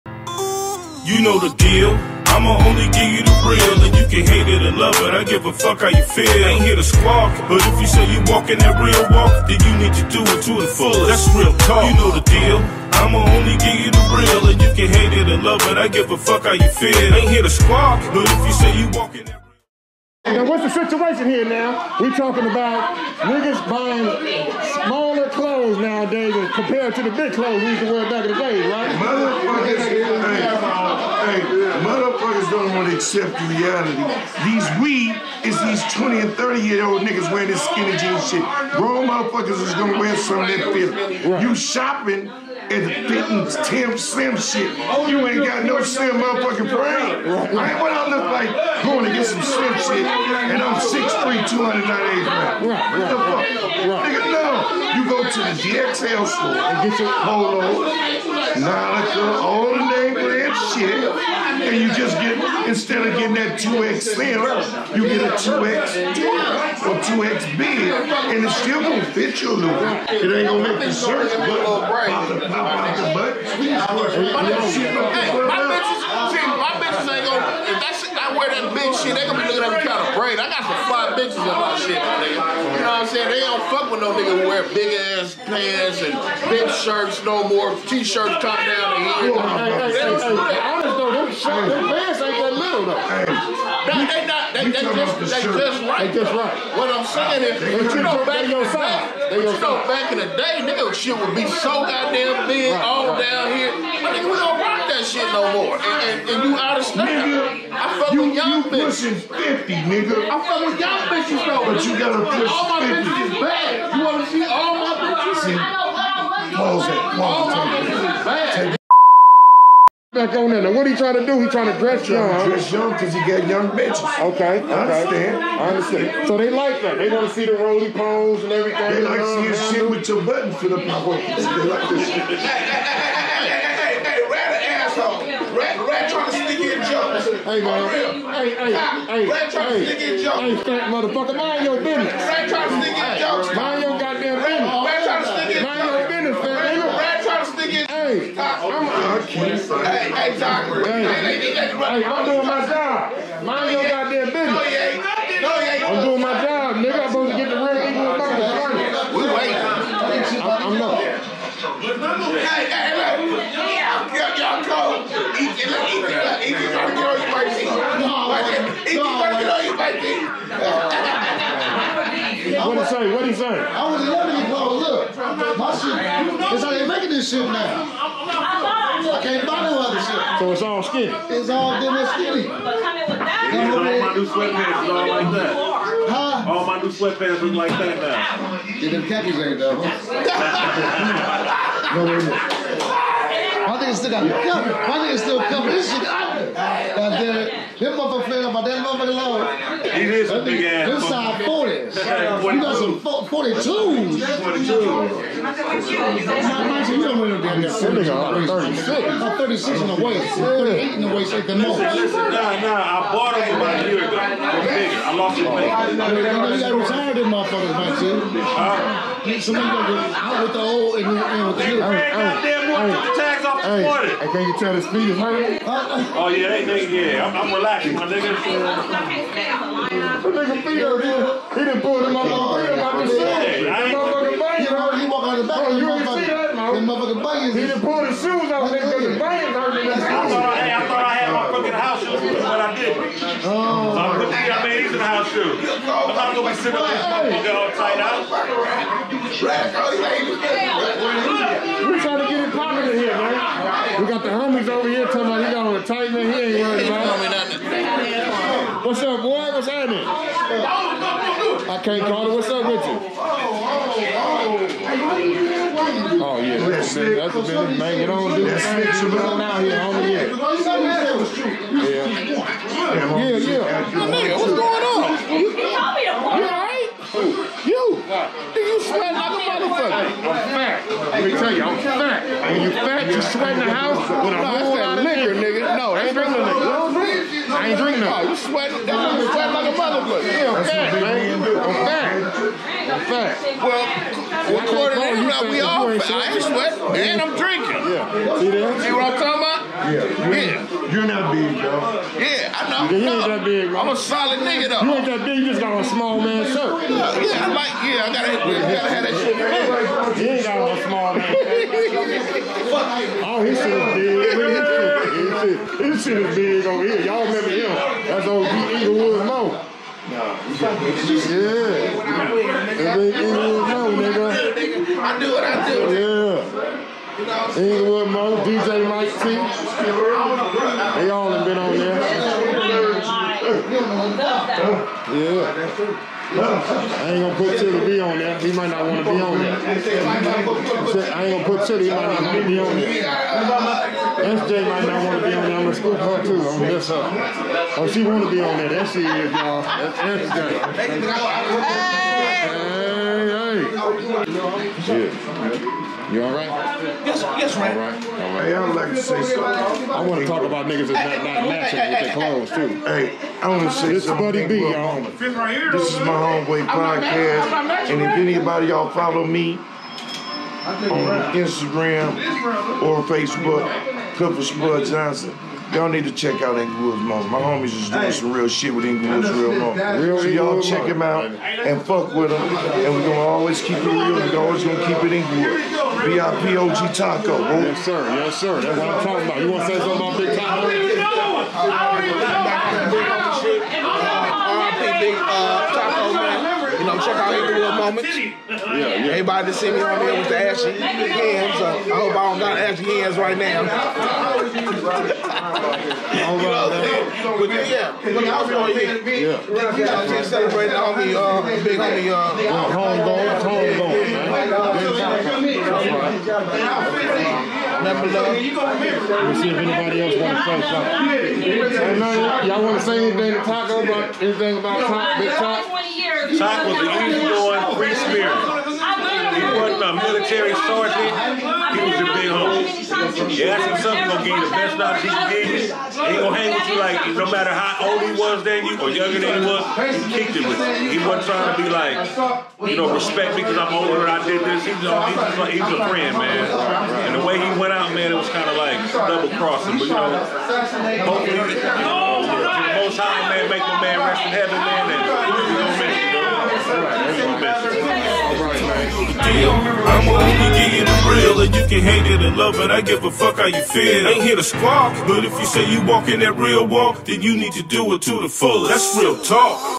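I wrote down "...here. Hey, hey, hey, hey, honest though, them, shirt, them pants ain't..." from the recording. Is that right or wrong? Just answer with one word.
right.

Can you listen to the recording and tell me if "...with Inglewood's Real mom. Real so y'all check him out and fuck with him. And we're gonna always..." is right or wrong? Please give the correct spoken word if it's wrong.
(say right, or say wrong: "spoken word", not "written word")
right.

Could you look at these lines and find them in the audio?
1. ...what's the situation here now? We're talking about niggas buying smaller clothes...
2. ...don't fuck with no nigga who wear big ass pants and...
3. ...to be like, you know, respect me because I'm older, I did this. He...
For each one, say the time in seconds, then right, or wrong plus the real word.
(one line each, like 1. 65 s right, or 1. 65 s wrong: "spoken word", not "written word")
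1. 20 s right
2. 83 s right
3. 441 s right.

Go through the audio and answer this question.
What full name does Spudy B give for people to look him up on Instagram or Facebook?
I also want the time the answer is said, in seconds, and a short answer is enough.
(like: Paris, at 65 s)
Clifford Spud Johnson, at 374 s.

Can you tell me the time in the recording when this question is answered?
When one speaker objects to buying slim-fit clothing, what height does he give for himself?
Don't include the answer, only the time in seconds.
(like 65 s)
50 s.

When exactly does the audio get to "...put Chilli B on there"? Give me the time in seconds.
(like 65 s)
337 s.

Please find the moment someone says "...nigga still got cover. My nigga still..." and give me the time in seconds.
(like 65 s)
193 s.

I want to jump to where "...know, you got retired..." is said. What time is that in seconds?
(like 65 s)
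216 s.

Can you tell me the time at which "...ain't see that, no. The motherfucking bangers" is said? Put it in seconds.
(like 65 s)
235 s.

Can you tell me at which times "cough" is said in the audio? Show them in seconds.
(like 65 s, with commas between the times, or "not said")
not said.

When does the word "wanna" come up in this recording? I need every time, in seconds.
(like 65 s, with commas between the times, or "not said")
114 s, 389 s.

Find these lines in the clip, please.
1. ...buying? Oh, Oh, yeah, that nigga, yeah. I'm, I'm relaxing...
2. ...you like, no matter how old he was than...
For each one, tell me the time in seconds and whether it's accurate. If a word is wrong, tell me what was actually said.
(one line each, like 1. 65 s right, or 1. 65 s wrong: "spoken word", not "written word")
1. 225 s wrong: "hurting", not "buying"
2. 436 s right.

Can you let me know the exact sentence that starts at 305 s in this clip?
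You just got a small man shirt.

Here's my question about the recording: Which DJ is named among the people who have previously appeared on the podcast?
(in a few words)
DJ Mike T.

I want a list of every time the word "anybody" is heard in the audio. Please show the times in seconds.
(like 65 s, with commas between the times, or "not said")
368 s, 419 s.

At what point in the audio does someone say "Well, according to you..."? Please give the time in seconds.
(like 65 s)
293 s.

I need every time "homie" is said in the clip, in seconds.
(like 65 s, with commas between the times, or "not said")
269 s, 377 s, 411 s, 432 s.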